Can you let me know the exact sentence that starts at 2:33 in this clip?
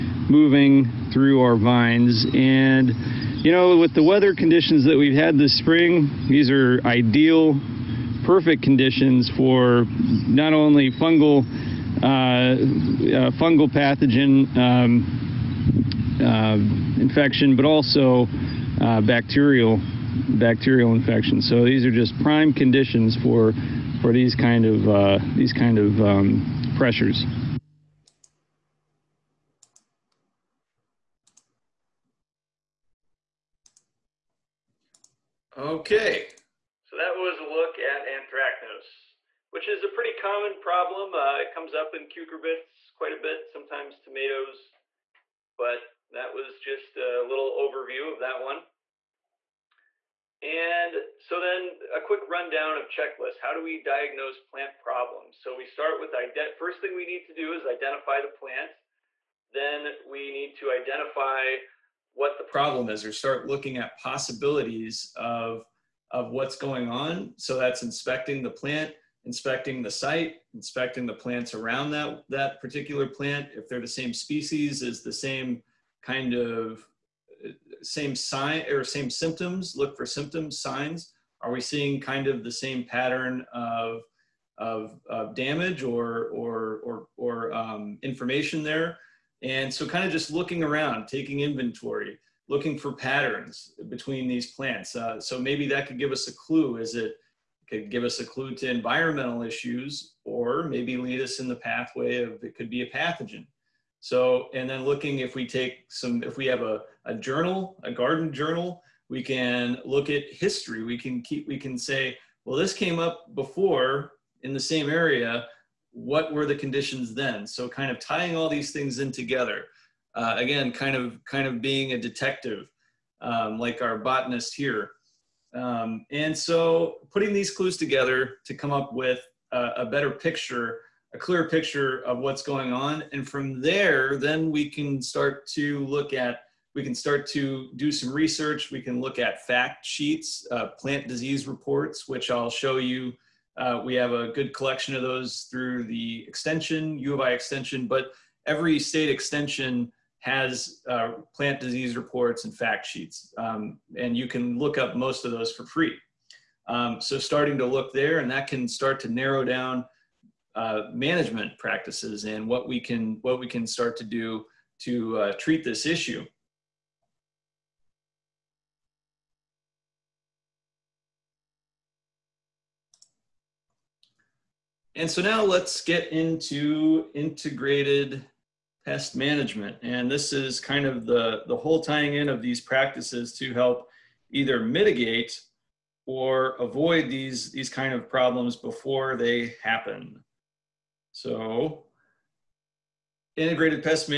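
Um, and you can look up most of those for free.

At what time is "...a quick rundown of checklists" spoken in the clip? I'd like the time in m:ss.
0:51.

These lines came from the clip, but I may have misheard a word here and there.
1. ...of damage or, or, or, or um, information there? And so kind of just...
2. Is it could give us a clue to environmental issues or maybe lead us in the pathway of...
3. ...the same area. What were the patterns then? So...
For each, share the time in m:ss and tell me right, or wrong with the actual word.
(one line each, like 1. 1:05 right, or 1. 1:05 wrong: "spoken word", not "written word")
1. 1:25 right
2. 1:36 right
3. 1:54 wrong: "conditions", not "patterns".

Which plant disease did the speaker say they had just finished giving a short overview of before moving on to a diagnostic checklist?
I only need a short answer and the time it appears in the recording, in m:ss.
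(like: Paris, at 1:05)
Anthracnose, at 0:38.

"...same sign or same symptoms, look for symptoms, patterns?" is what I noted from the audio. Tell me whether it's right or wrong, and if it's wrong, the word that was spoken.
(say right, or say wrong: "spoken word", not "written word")
wrong: "signs", not "patterns".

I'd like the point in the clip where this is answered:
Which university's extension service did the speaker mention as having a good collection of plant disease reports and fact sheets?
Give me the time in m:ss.
2:26.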